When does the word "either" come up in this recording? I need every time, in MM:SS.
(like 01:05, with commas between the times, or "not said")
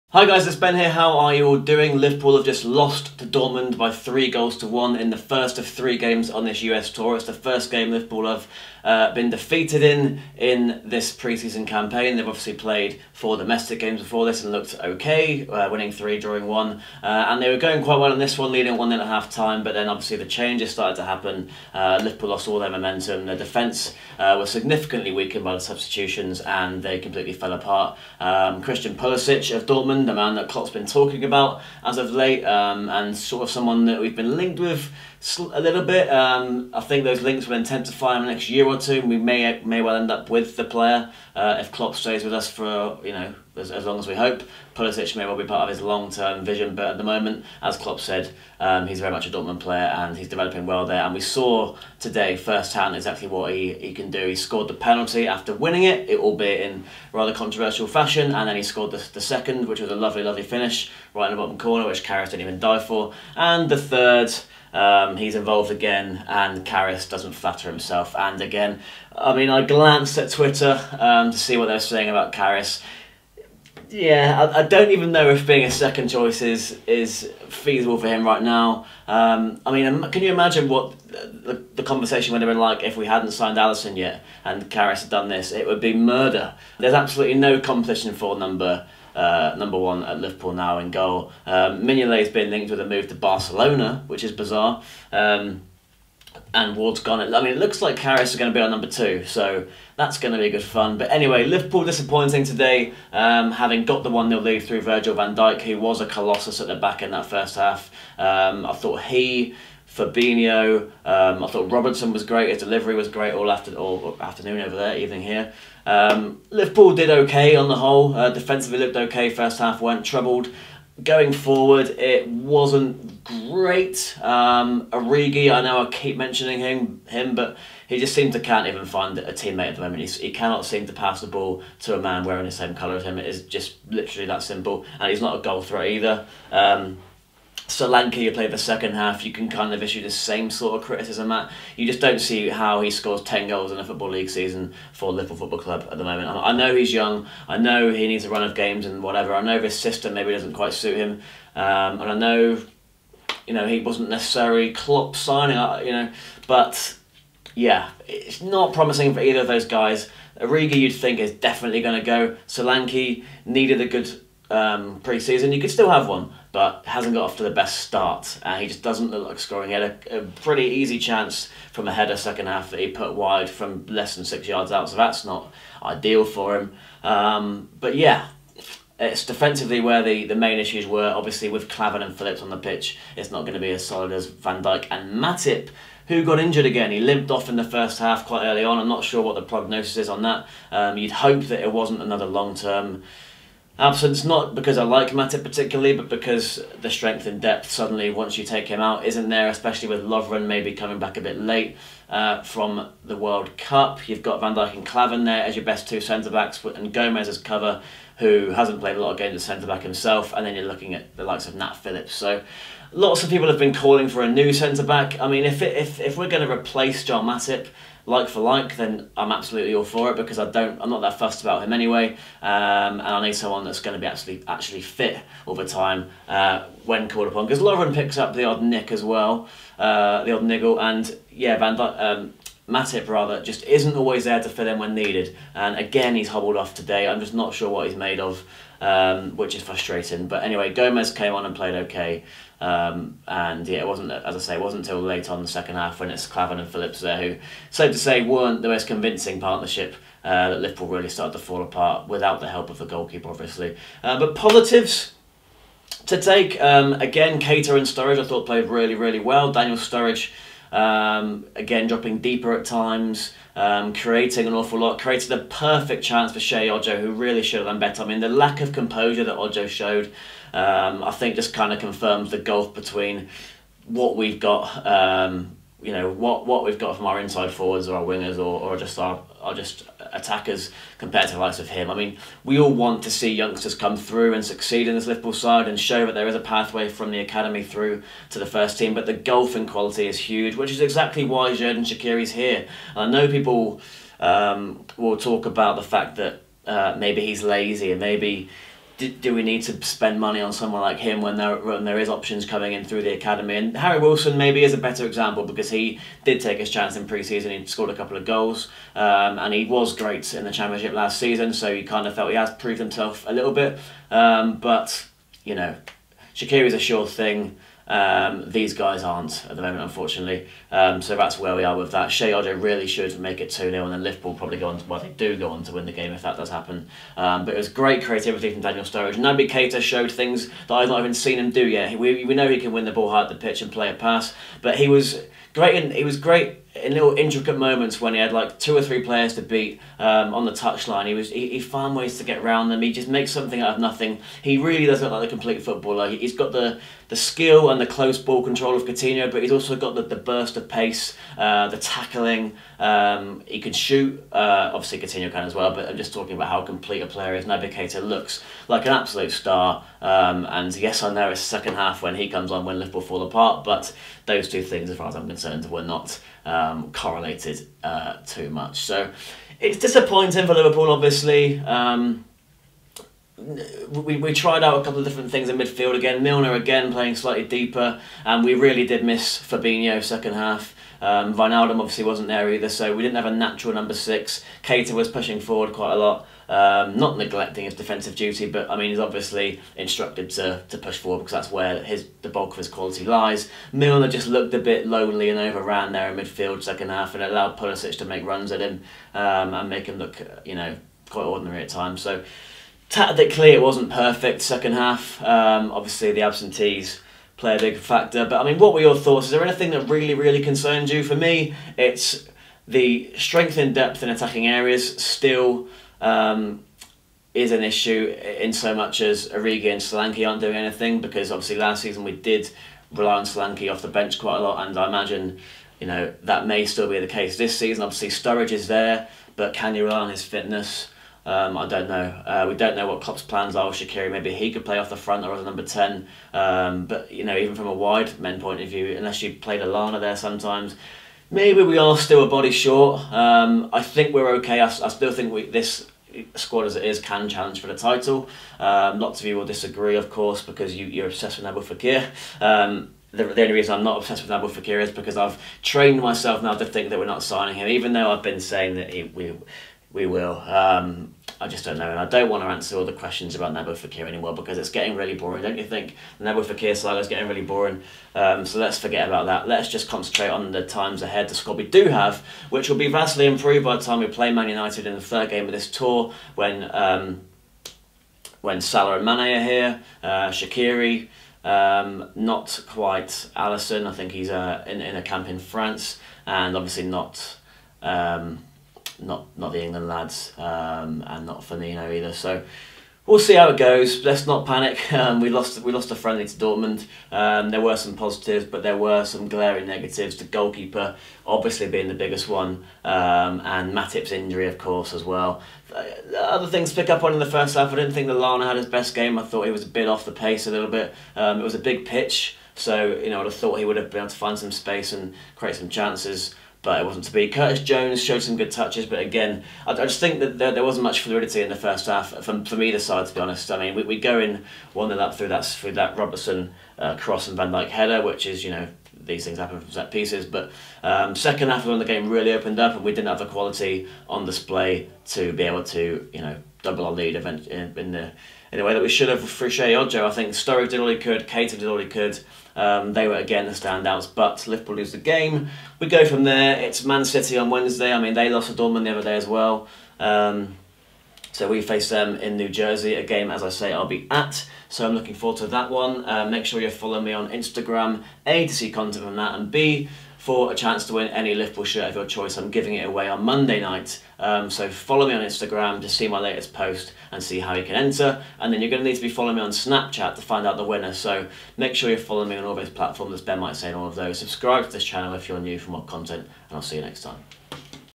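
02:15, 02:39, 06:22, 08:11, 08:42.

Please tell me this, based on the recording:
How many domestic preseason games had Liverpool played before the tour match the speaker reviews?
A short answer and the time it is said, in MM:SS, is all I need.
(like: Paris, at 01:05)
4, at 00:13.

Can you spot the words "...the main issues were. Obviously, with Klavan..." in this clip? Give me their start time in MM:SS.
03:00.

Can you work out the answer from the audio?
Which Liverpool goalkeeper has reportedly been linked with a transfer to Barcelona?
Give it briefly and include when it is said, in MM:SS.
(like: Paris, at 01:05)
Mignolet, at 01:31.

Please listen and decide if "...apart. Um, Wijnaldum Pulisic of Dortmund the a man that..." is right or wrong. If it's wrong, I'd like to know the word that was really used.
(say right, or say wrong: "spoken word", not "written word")
wrong: "Christian", not "Wijnaldum".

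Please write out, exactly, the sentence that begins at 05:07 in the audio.
He scored a couple of goals, um, and he was great in the championship last season.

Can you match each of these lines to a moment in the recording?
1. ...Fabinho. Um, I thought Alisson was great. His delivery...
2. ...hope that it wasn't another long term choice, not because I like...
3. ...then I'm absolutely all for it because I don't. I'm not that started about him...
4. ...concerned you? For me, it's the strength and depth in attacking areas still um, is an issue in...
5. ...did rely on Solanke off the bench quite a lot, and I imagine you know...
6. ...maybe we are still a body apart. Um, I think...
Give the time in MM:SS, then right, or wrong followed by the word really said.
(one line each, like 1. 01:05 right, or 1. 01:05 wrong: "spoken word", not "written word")
1. 01:49 wrong: "Robertson", not "Alisson"
2. 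03:11 wrong: "absence", not "choice"
3. 03:38 wrong: "fussed", not "started"
4. 06:50 right
5. 07:02 right
6. 07:21 wrong: "short", not "apart".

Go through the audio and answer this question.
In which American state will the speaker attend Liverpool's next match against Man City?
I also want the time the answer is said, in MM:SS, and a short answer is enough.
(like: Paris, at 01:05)
New Jersey, at 09:12.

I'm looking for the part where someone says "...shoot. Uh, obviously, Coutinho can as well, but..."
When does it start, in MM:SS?
05:53.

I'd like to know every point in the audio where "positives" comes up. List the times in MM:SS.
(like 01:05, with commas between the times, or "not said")
04:14, 08:17.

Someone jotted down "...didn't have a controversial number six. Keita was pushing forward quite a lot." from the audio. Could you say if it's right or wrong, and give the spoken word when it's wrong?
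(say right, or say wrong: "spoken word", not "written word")
wrong: "natural", not "controversial".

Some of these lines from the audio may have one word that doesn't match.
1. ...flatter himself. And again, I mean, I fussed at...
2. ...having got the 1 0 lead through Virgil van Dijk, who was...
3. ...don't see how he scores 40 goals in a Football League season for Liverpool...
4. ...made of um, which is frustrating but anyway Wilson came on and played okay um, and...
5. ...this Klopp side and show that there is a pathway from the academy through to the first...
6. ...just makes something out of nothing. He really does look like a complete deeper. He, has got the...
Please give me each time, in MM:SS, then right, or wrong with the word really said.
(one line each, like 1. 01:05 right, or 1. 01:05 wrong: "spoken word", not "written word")
1. 01:07 wrong: "glanced", not "fussed"
2. 01:43 right
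3. 02:22 wrong: "10", not "40"
4. 03:57 wrong: "Gomez", not "Wilson"
5. 04:44 wrong: "Liverpool", not "Klopp"
6. 05:42 wrong: "footballer", not "deeper".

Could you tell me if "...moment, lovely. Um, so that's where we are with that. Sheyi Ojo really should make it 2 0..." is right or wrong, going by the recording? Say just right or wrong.
wrong.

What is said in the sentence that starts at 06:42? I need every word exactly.
So tactically, it wasn't perfect second half.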